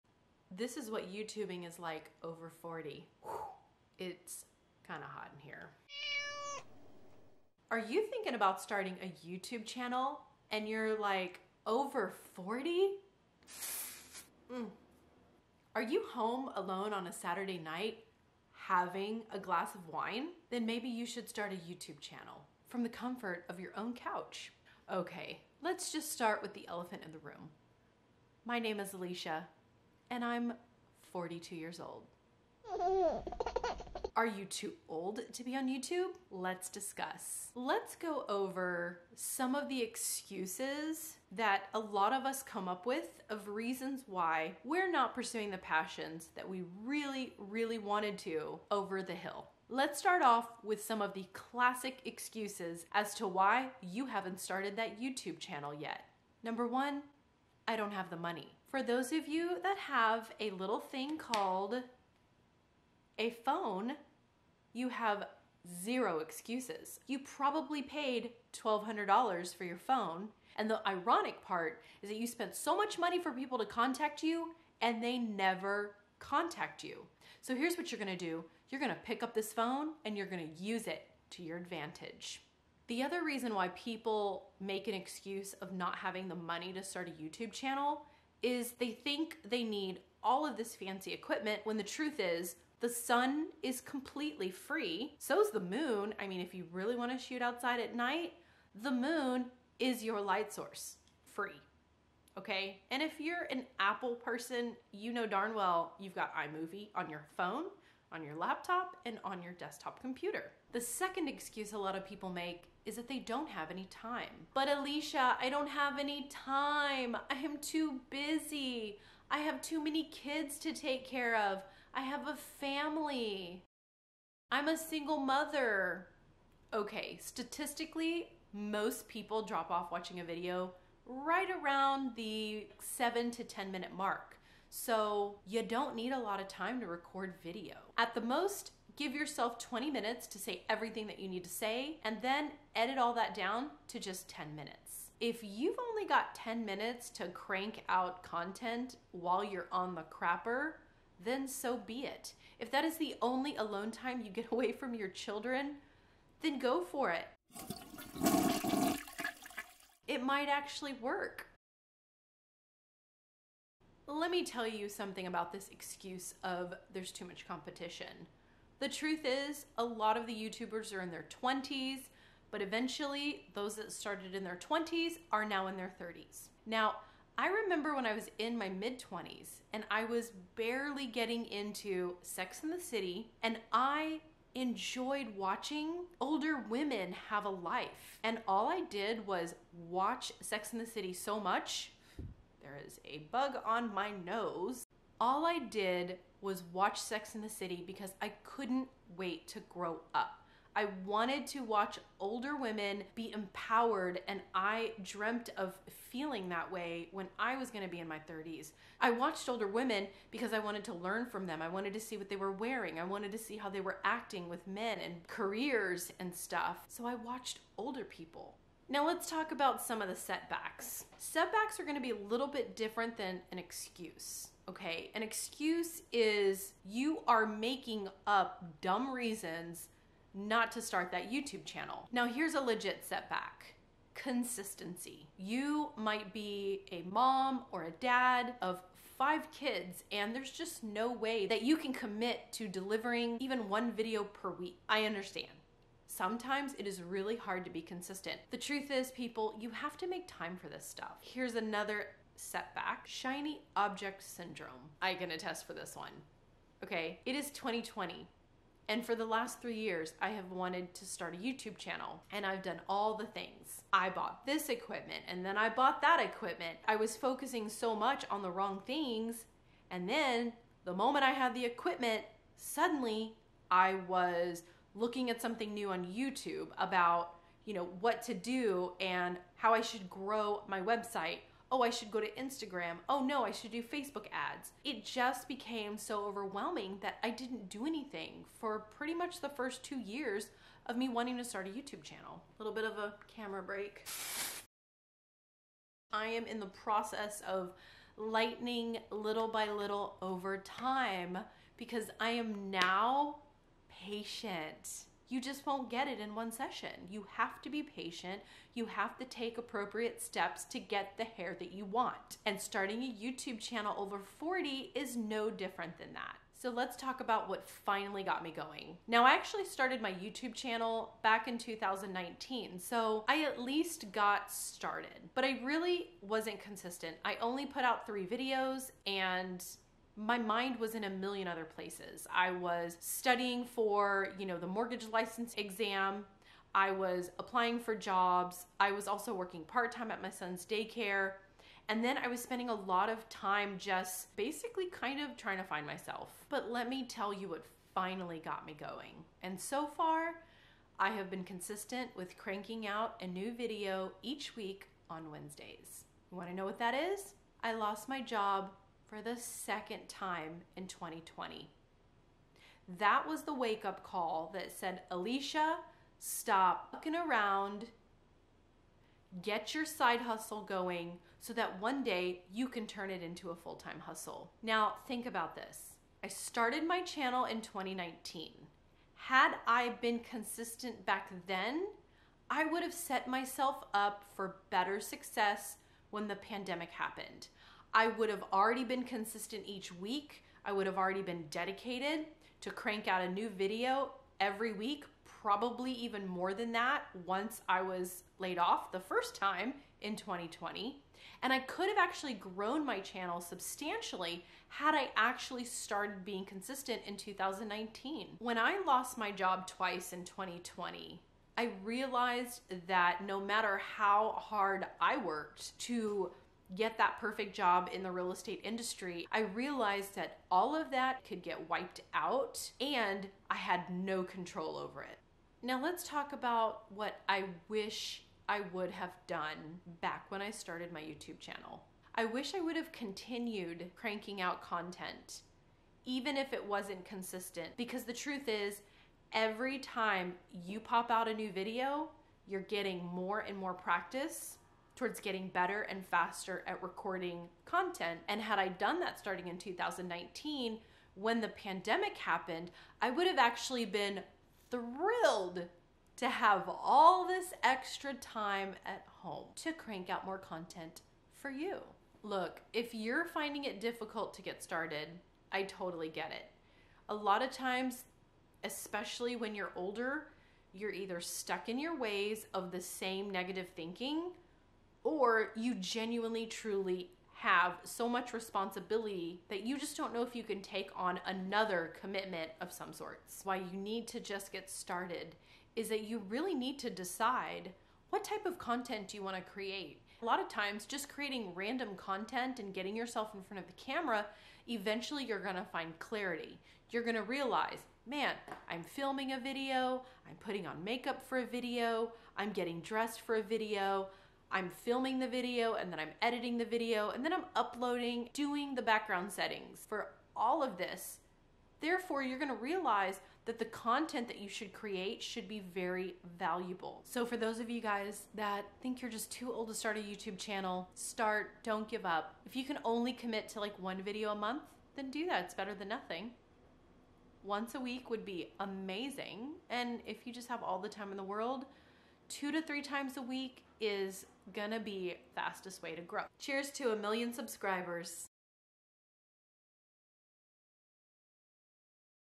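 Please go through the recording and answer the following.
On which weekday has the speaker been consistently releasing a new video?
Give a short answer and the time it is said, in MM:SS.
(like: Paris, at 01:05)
Wednesdays, at 05:55.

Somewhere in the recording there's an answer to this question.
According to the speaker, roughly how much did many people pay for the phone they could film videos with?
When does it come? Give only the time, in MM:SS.
01:08.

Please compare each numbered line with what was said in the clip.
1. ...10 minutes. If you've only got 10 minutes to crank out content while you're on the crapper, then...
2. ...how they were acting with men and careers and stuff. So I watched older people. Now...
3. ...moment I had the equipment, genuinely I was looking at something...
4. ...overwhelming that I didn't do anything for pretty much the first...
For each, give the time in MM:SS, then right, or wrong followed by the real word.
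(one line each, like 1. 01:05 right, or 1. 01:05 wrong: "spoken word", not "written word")
1. 02:24 right
2. 03:33 right
3. 04:30 wrong: "suddenly", not "genuinely"
4. 04:46 right.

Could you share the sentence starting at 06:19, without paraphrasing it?
Had I been consistent back then, I would have set myself up for better success when the pandemic happened.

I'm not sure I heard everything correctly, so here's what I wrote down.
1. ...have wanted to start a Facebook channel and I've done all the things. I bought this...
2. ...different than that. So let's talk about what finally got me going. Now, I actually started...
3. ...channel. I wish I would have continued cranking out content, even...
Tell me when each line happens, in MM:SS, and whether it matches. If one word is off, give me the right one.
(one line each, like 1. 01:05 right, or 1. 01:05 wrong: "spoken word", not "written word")
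1. 04:20 wrong: "YouTube", not "Facebook"
2. 05:15 right
3. 07:11 right.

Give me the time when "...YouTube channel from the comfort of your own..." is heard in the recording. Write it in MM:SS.
00:21.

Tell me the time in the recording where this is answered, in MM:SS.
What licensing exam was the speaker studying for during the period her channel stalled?
05:34.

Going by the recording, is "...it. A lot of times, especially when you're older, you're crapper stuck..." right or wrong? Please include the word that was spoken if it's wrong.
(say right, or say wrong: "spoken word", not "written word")
wrong: "either", not "crapper".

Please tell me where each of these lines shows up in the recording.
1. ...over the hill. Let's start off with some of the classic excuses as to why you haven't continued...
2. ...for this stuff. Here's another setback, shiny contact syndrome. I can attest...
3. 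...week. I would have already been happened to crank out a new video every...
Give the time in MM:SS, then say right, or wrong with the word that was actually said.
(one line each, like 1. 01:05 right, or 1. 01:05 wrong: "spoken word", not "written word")
1. 00:48 wrong: "started", not "continued"
2. 04:10 wrong: "object", not "contact"
3. 06:29 wrong: "dedicated", not "happened".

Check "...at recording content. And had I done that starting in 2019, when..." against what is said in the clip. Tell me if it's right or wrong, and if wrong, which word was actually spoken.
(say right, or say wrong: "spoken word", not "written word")
right.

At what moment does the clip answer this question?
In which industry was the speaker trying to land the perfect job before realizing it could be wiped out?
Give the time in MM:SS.
06:58.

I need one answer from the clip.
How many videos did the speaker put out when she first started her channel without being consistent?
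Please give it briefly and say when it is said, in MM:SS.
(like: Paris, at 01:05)
3, at 05:28.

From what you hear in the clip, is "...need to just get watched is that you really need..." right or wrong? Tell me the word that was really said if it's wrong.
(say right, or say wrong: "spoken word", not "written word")
wrong: "started", not "watched".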